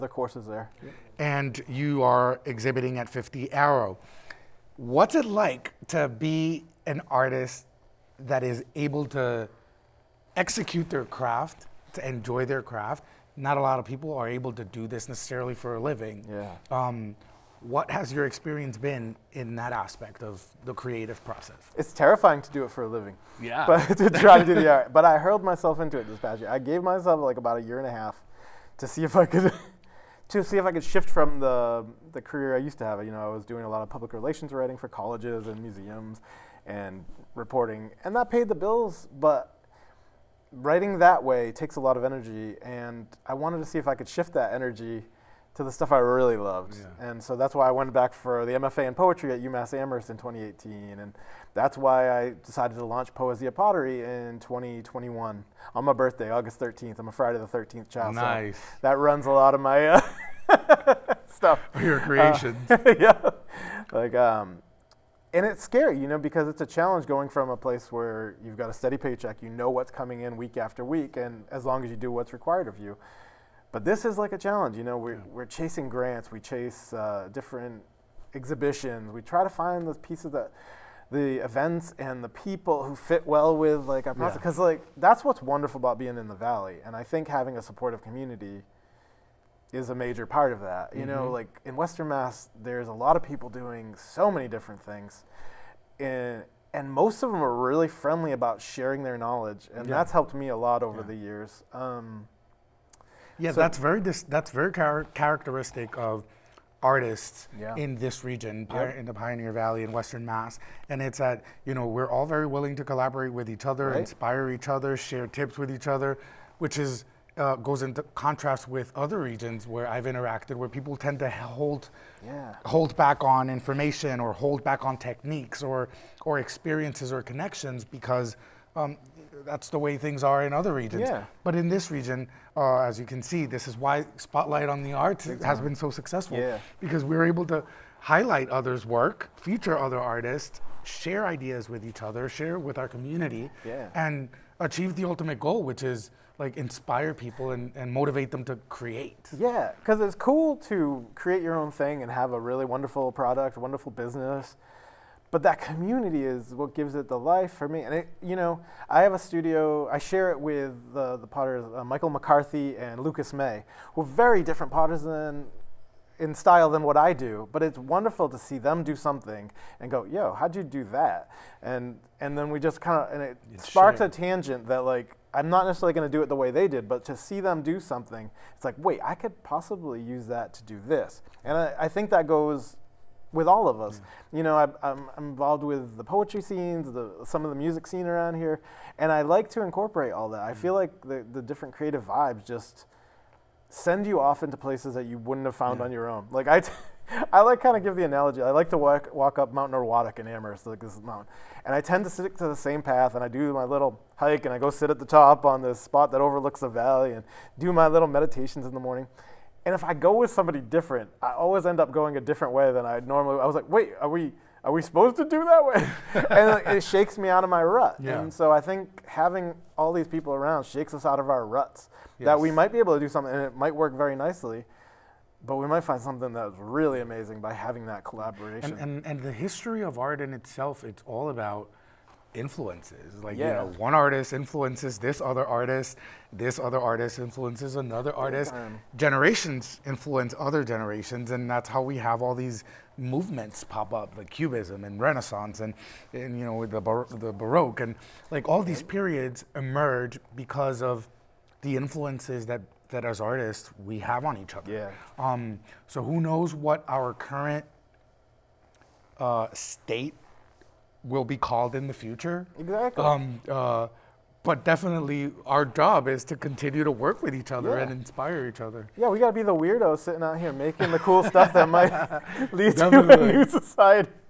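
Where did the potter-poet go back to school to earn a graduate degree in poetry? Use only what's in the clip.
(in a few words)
UMass Amherst.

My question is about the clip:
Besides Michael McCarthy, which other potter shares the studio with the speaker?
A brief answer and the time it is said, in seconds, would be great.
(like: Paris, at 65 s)
Lucas May, at 163 s.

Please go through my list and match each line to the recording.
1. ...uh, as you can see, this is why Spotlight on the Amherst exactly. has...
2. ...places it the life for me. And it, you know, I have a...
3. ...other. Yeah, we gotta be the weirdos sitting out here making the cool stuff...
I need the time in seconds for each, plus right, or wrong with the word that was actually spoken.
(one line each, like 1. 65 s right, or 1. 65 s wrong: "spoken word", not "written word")
1. 132 s wrong: "Arts", not "Amherst"
2. 156 s wrong: "gives", not "places"
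3. 268 s right.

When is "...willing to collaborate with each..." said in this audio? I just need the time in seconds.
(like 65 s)
112 s.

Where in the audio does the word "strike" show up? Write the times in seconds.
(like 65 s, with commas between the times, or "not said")
not said.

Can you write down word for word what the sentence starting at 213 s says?
I was like, wait, are we are we supposed to do that way?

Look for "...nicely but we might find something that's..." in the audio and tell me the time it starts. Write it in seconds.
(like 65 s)
224 s.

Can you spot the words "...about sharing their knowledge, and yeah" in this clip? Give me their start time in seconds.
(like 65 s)
98 s.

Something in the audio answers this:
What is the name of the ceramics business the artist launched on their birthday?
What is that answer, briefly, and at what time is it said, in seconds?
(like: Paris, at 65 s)
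Poesia Pottery, at 53 s.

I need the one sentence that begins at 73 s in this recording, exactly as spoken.
But this is like a challenge, you know, we're, yeah.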